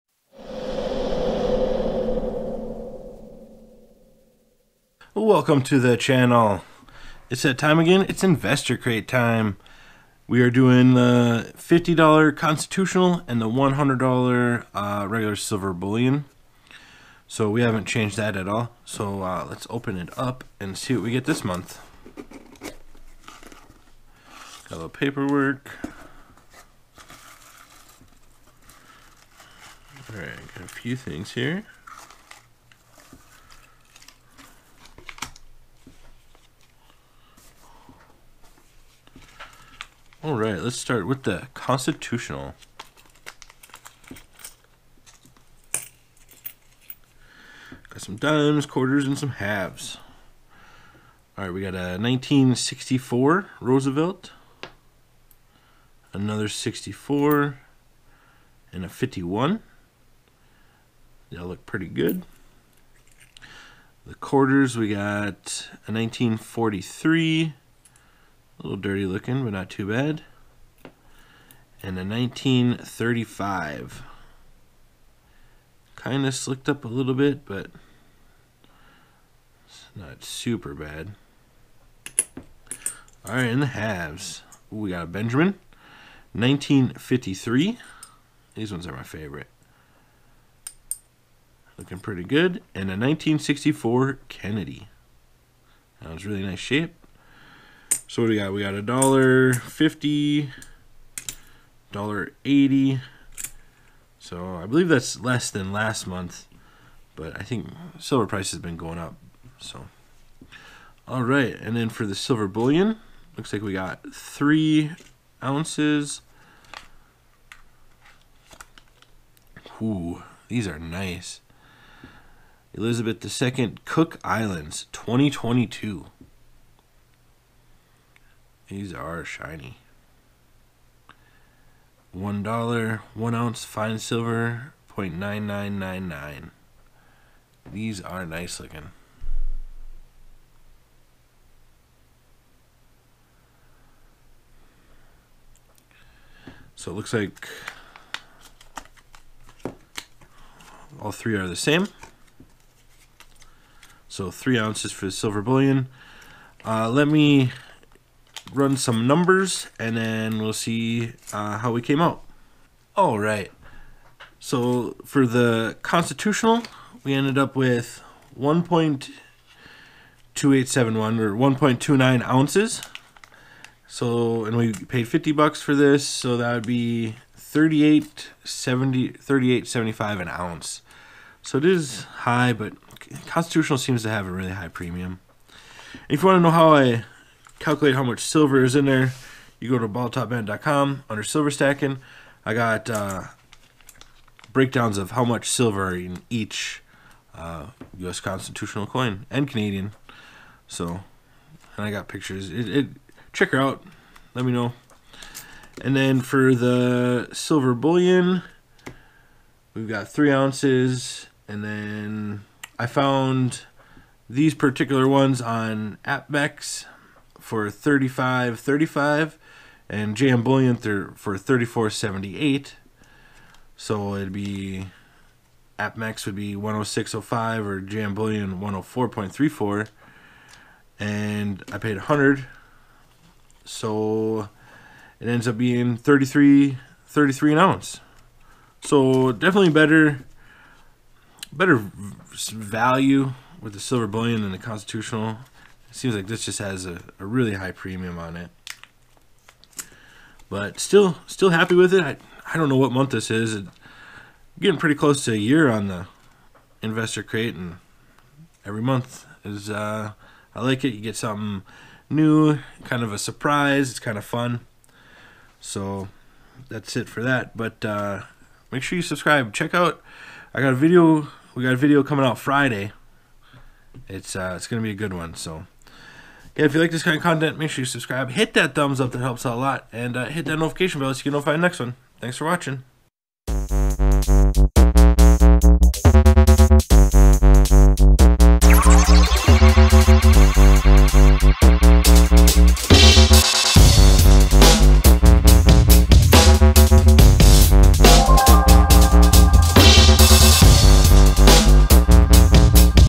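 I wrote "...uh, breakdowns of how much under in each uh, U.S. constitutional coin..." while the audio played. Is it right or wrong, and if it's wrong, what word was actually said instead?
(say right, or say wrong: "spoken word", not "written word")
wrong: "silver", not "under".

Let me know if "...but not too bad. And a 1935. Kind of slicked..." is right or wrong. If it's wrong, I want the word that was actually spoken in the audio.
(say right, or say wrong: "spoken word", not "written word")
right.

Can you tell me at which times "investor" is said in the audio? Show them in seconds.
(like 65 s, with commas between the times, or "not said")
8 s, 256 s.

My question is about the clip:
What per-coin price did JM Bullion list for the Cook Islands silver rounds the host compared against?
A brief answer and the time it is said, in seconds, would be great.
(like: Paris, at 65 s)
$34.78, at 221 s.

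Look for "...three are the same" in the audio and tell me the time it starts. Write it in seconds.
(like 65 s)
151 s.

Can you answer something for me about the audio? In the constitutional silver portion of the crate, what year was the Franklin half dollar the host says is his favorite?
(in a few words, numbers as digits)
1953.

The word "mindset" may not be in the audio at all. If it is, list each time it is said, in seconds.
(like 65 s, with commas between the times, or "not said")
not said.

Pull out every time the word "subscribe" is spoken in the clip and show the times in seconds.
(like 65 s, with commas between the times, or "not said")
269 s, 277 s.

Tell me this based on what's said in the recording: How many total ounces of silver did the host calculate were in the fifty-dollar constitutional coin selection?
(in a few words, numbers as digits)
1.2871.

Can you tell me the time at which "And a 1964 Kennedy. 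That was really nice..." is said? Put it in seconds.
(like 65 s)
92 s.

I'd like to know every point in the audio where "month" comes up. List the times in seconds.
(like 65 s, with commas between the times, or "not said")
21 s, 106 s, 252 s, 258 s.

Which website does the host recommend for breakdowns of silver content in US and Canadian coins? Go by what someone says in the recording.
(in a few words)
bottletopbandit.com.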